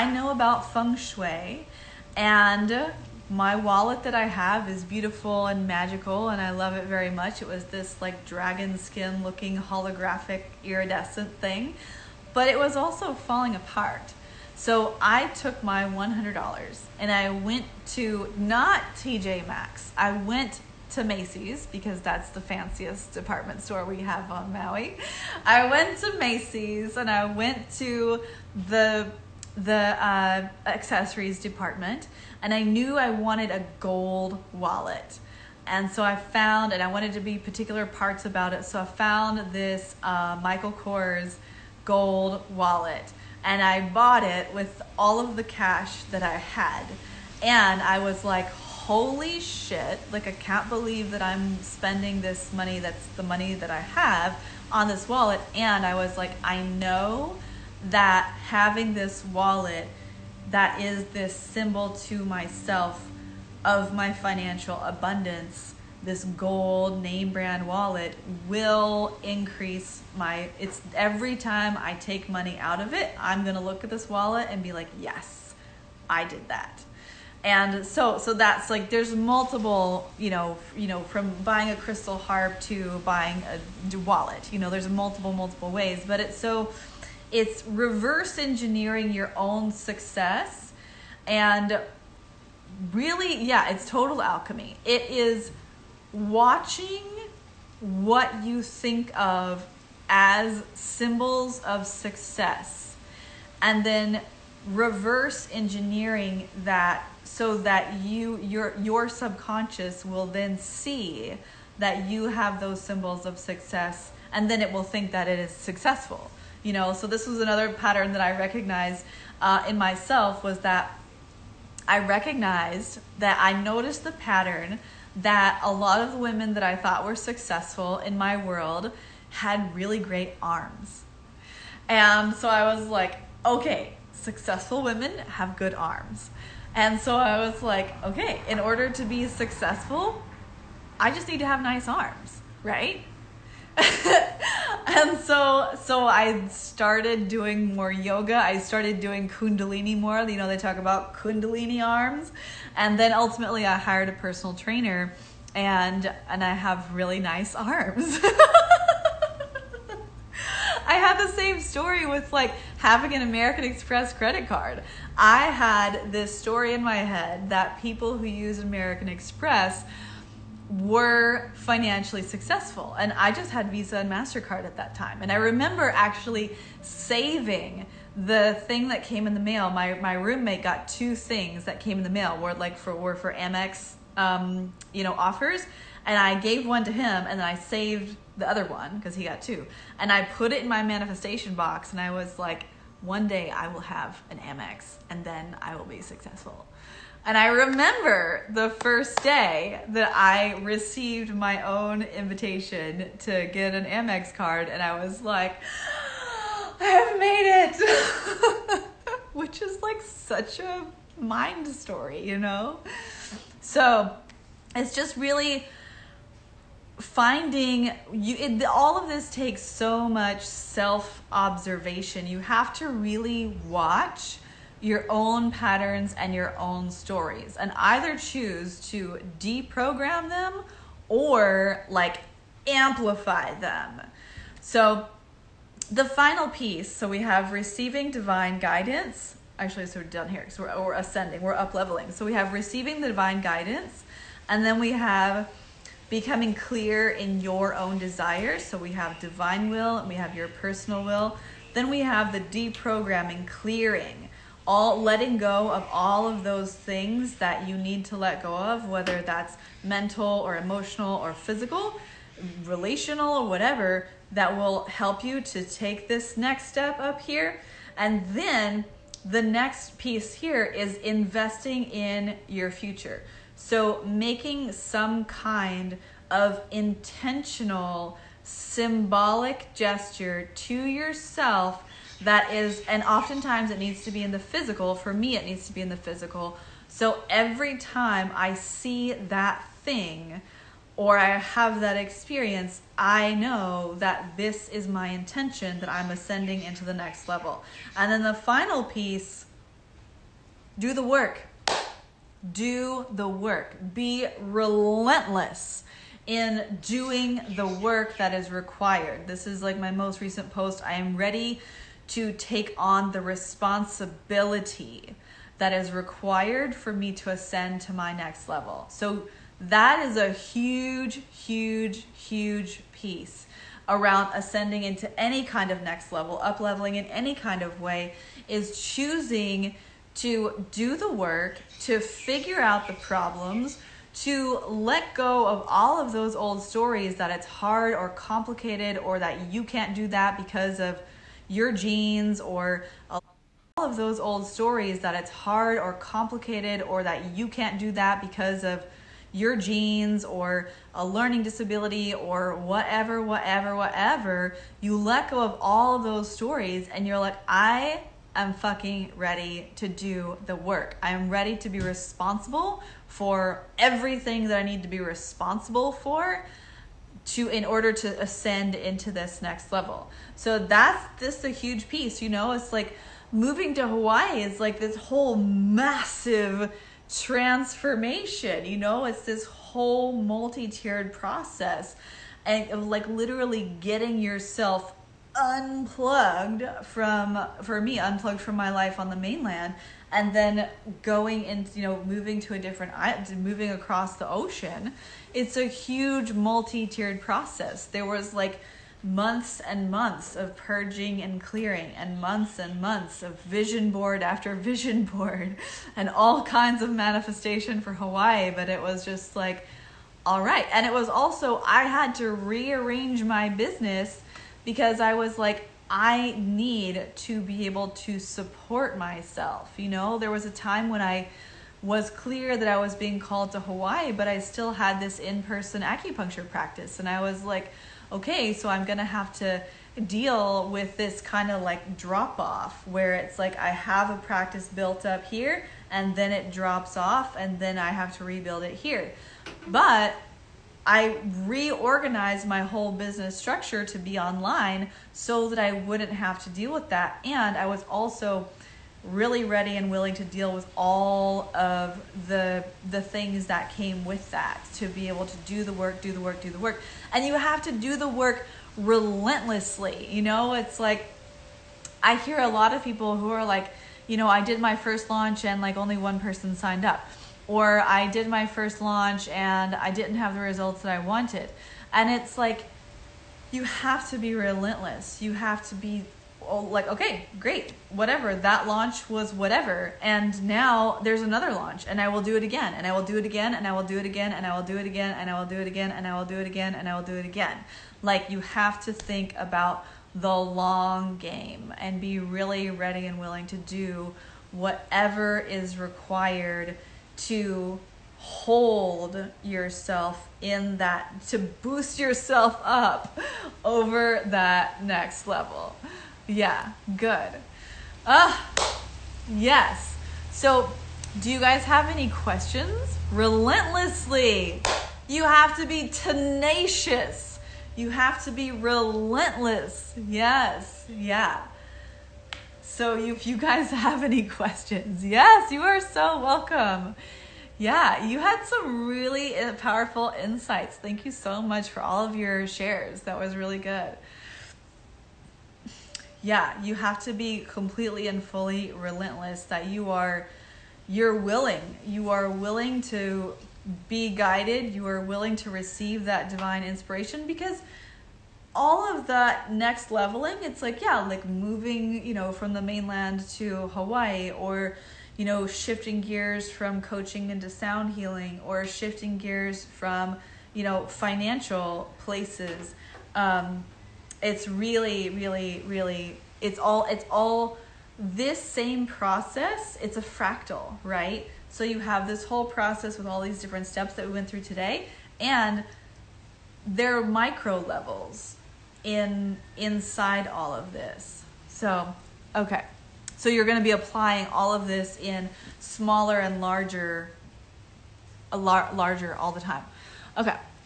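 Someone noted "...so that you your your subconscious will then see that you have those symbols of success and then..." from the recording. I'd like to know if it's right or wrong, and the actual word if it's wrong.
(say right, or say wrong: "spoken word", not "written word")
right.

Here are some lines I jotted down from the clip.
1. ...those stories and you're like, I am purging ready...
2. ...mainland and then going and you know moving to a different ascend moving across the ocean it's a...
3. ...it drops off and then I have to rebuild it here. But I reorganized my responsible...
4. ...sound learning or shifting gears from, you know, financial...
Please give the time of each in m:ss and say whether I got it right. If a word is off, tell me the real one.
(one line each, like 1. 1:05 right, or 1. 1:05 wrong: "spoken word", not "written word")
1. 5:56 wrong: "fucking", not "purging"
2. 6:29 wrong: "island", not "ascend"
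3. 7:16 wrong: "whole", not "responsible"
4. 9:17 wrong: "healing", not "learning".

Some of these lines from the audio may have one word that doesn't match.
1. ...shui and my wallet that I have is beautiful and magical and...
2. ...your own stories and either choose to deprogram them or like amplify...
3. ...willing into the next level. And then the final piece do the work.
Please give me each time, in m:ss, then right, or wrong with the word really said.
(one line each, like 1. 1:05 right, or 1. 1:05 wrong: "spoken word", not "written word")
1. 0:00 right
2. 3:46 right
3. 4:56 wrong: "ascending", not "willing".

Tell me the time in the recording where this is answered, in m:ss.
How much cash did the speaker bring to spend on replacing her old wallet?
0:15.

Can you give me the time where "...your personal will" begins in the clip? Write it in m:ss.
4:10.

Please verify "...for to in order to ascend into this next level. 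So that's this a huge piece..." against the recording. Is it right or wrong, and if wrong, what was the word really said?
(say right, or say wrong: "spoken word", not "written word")
right.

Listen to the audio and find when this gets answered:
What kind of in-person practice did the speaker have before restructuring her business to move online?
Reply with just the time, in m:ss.
7:05.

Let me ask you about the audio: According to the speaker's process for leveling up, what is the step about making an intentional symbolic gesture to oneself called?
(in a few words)
Investing in your future.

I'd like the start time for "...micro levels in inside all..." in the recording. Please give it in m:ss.
9:37.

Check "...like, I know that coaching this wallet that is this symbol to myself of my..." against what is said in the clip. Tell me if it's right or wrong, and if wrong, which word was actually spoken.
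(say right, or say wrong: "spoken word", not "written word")
wrong: "having", not "coaching".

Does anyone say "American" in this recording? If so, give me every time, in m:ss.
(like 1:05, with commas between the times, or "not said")
2:43, 2:48.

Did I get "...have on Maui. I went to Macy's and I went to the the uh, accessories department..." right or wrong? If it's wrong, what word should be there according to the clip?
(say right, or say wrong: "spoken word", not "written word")
right.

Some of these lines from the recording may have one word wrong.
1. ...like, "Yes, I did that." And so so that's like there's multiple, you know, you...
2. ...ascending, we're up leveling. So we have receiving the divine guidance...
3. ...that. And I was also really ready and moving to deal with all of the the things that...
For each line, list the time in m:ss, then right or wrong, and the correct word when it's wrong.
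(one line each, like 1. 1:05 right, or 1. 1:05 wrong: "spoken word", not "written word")
1. 1:14 right
2. 4:00 right
3. 7:26 wrong: "willing", not "moving".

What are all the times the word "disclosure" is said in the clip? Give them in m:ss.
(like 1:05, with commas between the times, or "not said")
not said.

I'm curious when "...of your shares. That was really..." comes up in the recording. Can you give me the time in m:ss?
8:52.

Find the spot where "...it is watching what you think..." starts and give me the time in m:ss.
1:34.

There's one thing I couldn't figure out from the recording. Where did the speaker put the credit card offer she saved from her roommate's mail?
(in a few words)
Manifestation box.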